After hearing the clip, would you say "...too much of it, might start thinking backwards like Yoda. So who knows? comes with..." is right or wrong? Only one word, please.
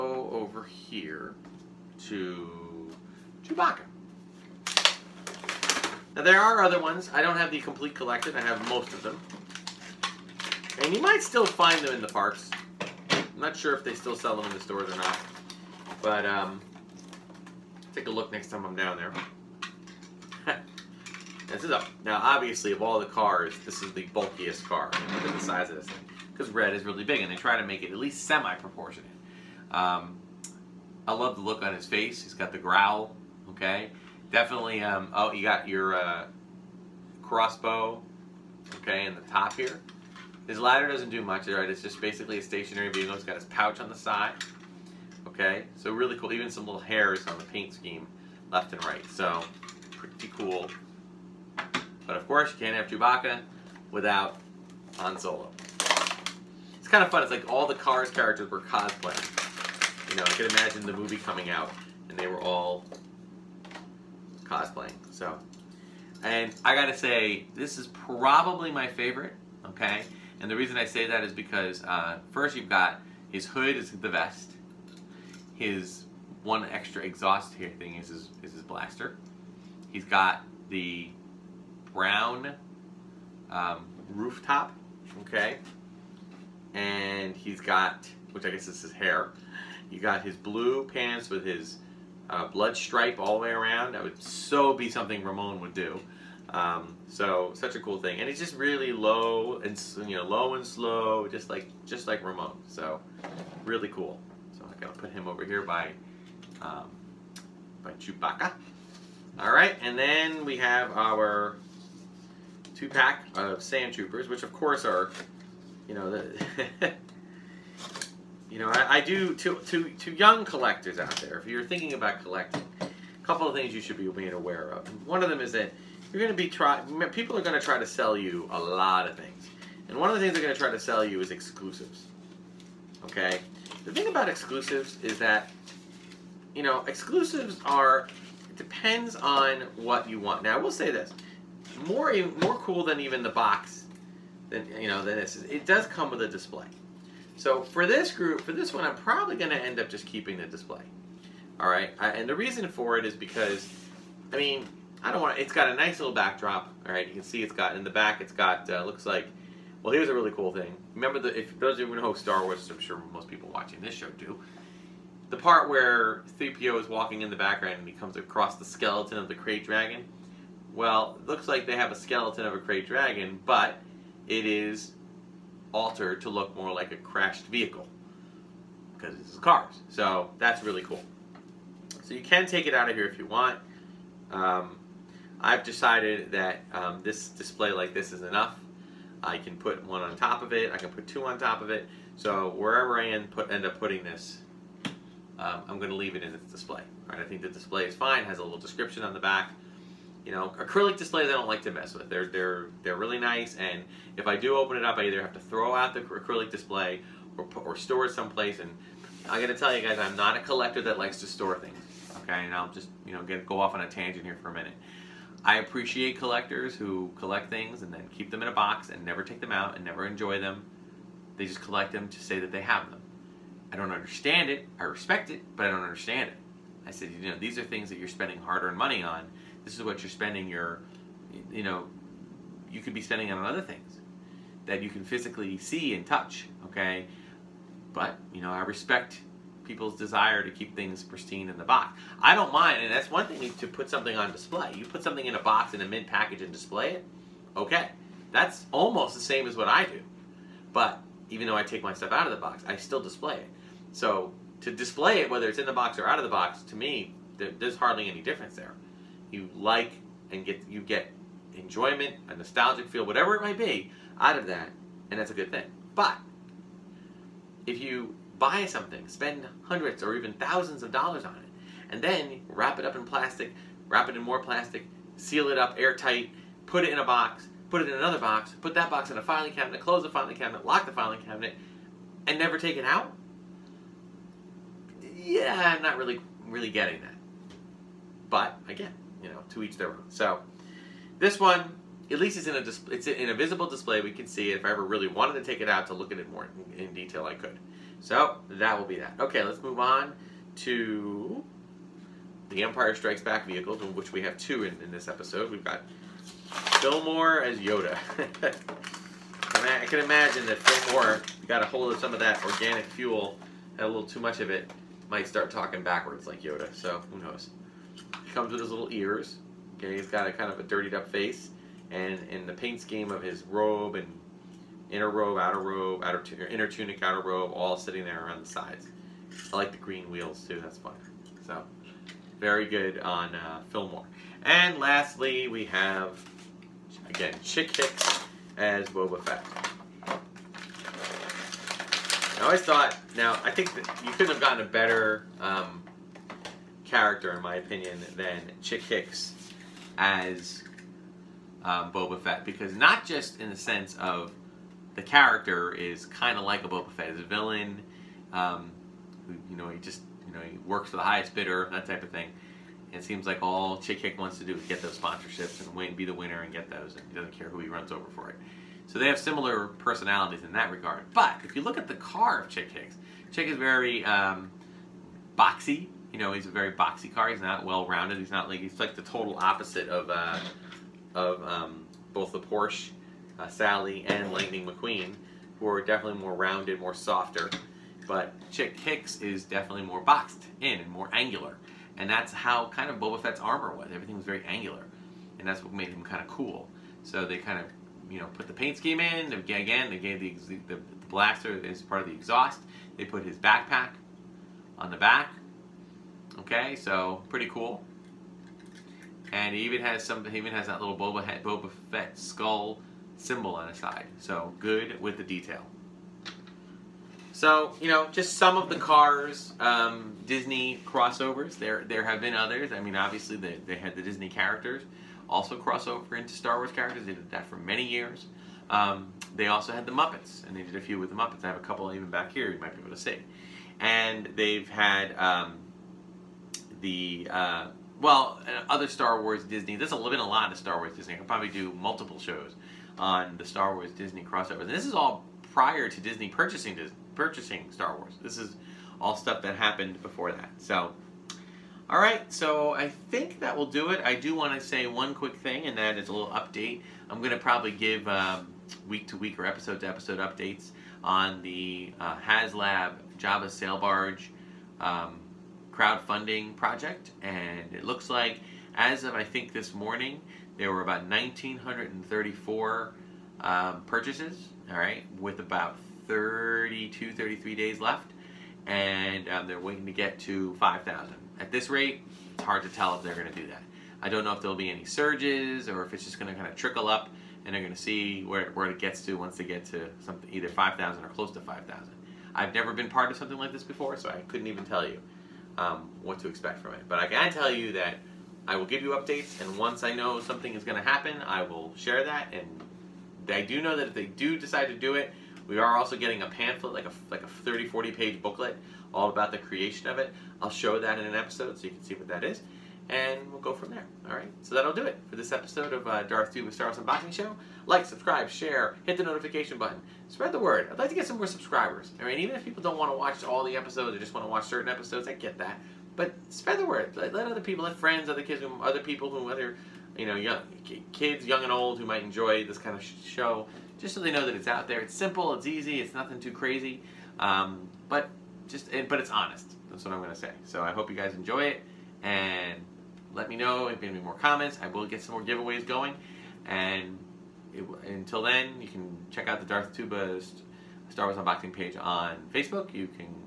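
wrong.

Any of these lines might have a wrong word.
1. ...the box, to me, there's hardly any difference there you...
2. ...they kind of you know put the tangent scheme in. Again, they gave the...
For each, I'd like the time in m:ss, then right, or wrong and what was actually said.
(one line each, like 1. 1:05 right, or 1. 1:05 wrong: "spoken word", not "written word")
1. 4:16 right
2. 6:37 wrong: "paint", not "tangent".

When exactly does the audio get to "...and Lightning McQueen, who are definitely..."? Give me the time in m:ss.
6:24.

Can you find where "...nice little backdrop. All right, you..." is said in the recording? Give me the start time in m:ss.
2:35.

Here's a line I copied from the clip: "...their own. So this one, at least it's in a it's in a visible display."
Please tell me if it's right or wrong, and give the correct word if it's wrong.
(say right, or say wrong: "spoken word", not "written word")
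right.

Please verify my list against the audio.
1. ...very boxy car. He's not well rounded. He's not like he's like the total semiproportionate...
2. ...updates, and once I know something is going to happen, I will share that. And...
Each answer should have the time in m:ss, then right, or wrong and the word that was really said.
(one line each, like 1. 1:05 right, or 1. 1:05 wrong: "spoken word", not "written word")
1. 6:16 wrong: "opposite", not "semiproportionate"
2. 8:18 right.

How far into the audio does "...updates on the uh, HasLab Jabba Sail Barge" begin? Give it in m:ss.
7:40.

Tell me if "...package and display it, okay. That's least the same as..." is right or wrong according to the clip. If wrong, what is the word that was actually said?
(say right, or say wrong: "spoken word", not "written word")
wrong: "almost", not "least".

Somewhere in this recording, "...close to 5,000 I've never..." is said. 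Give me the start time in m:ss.
8:11.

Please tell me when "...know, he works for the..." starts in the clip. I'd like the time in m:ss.
6:00.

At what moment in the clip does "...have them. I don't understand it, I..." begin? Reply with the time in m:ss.
3:42.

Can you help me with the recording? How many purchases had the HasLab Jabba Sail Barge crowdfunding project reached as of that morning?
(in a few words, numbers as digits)
1934.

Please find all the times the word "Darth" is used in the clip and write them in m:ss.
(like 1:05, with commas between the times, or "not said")
8:36, 9:09.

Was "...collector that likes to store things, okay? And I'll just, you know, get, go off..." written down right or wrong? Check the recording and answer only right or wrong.
right.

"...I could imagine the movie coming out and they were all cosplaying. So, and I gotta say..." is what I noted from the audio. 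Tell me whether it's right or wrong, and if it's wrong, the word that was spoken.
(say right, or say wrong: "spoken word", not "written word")
right.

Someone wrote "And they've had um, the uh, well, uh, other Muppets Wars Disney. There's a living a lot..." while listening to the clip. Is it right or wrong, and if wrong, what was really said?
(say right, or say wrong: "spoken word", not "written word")
wrong: "Star", not "Muppets".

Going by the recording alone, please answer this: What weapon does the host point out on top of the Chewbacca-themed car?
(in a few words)
crossbow.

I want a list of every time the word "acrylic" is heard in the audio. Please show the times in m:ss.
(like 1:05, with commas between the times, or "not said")
3:20, 3:26.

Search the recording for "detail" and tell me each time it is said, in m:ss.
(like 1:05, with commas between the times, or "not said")
4:56, 6:55.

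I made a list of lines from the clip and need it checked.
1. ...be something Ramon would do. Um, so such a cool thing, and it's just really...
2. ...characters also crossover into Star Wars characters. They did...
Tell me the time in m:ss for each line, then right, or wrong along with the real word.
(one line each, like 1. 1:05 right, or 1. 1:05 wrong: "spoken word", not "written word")
1. 1:34 right
2. 7:04 right.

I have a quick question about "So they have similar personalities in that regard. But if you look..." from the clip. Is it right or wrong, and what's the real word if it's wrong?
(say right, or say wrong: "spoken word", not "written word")
right.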